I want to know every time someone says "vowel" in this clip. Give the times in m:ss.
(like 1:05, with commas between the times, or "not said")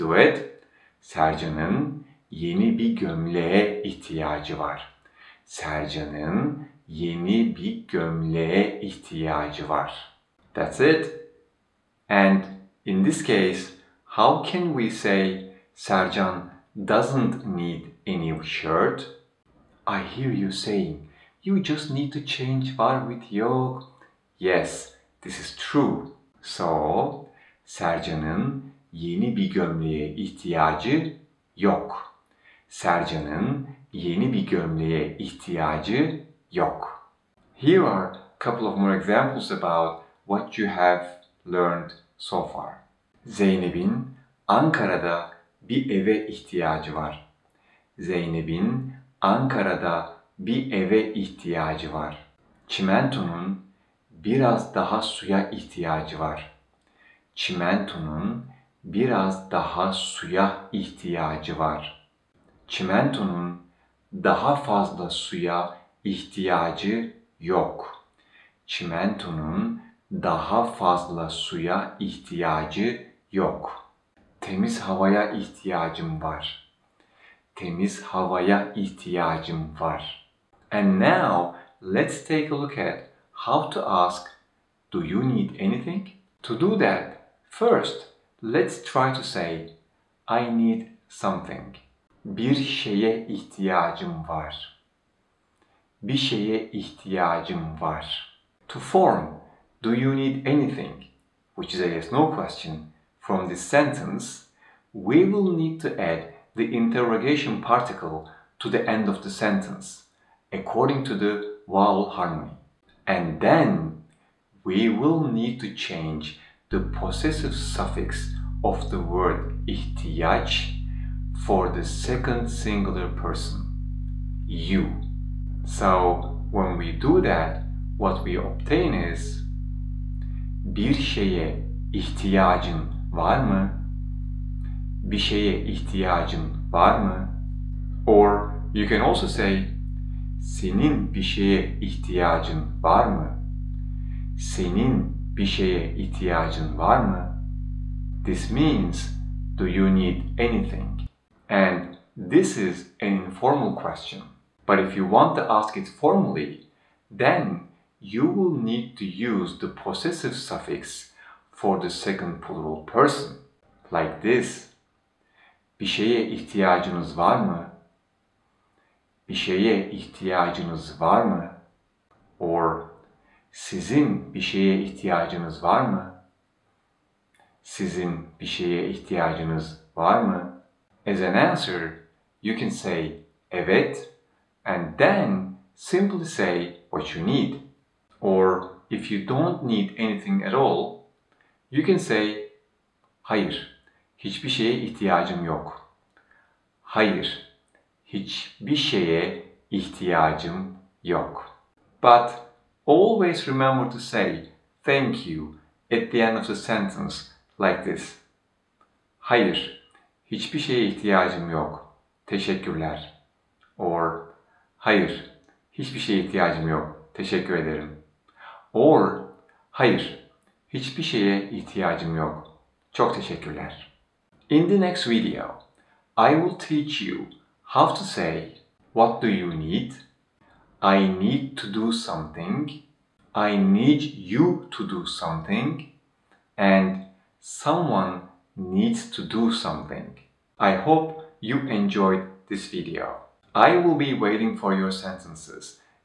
1:51.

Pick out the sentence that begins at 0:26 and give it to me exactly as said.
So, Sercan'ın yeni bir gömleğe ihtiyacı yok.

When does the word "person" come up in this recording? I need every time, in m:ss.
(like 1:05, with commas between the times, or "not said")
2:03, 2:42.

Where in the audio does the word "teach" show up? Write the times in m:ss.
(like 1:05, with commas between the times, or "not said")
3:46.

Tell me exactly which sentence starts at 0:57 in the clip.
Çimentonun biraz daha suya ihtiyacı var.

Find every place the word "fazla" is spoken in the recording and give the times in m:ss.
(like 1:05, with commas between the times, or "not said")
1:04, 1:10.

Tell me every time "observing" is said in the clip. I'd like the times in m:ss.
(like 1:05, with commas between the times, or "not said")
not said.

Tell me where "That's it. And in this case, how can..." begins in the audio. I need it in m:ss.
0:10.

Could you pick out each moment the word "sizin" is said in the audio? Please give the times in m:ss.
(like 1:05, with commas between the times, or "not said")
2:53, 2:57.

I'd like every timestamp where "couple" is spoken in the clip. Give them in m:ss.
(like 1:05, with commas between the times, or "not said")
0:38.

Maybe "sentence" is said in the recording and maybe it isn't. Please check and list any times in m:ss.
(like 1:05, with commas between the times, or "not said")
1:43, 1:49, 3:26, 4:04.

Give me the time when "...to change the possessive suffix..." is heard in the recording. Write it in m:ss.
1:55.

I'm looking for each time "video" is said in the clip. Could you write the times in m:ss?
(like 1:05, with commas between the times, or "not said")
3:45, 4:02.